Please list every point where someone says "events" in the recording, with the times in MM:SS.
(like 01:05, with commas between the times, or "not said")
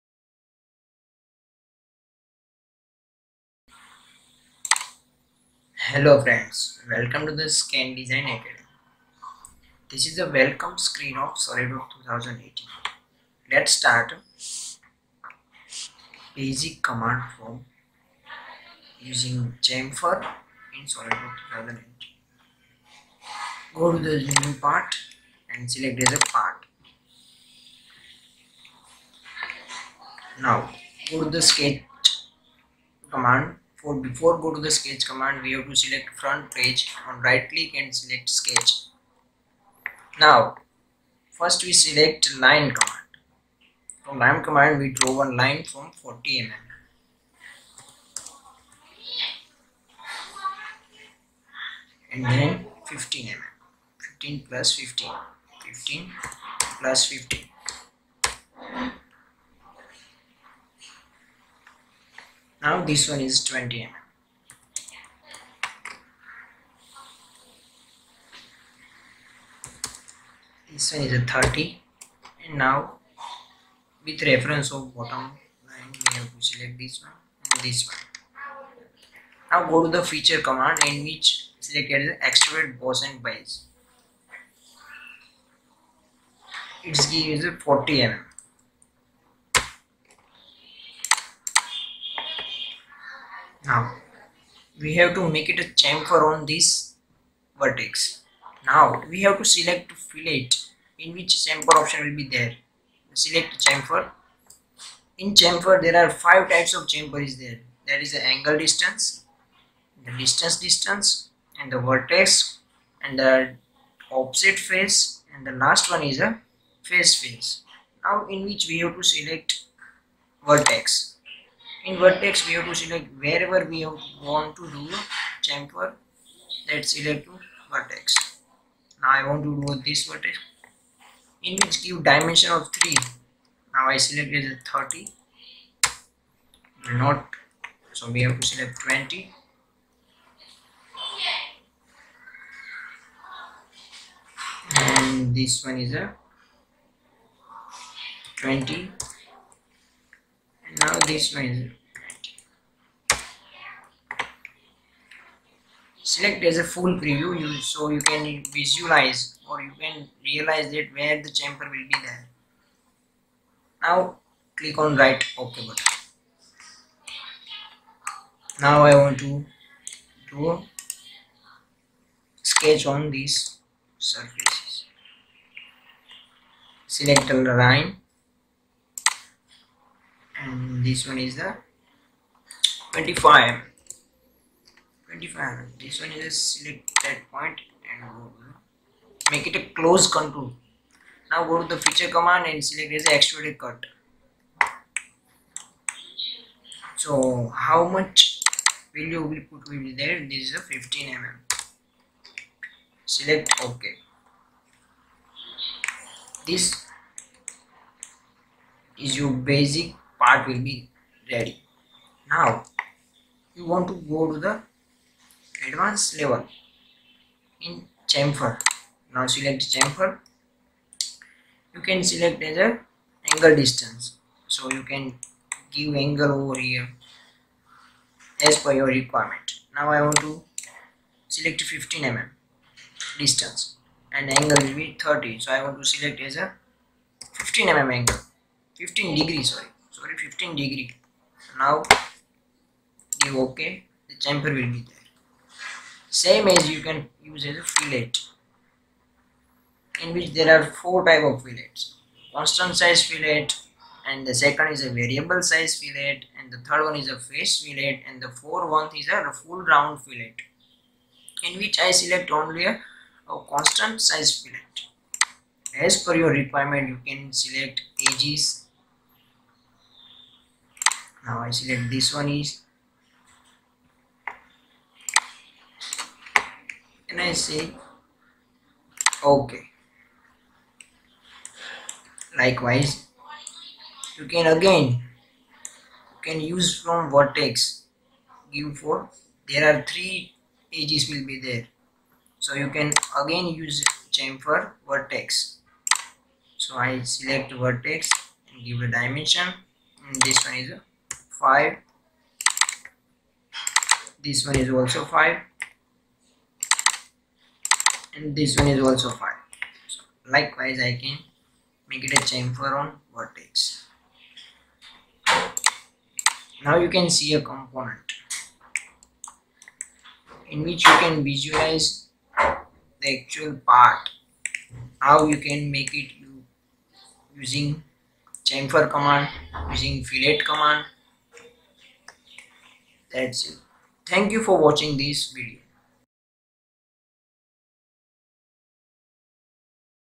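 not said.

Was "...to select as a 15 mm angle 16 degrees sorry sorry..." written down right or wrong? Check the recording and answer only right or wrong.
wrong.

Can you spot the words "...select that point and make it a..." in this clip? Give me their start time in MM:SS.
03:06.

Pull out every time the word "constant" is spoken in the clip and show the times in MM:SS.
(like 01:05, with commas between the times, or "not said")
04:12, 04:23.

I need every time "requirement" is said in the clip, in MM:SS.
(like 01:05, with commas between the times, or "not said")
03:48, 04:26.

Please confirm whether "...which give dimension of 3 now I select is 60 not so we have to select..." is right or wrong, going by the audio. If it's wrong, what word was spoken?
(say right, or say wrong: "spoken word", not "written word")
wrong: "30", not "60".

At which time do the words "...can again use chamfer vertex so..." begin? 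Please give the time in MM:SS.
04:52.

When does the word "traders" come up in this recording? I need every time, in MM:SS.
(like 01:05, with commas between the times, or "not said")
not said.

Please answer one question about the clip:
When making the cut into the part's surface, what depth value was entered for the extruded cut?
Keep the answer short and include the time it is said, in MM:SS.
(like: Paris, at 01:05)
15 mm, at 03:20.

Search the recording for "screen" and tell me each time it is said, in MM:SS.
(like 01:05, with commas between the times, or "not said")
00:10.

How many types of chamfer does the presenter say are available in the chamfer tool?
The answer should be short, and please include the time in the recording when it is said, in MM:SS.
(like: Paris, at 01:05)
5, at 01:46.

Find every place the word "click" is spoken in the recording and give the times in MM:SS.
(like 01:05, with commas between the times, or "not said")
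00:37, 02:44.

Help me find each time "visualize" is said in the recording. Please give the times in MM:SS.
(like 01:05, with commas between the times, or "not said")
02:38, 05:21.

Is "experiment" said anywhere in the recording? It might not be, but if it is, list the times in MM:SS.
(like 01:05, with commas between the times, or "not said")
not said.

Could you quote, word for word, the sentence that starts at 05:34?
Thank you for watching this video.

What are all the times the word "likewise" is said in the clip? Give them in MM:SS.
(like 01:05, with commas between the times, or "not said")
04:42, 05:10.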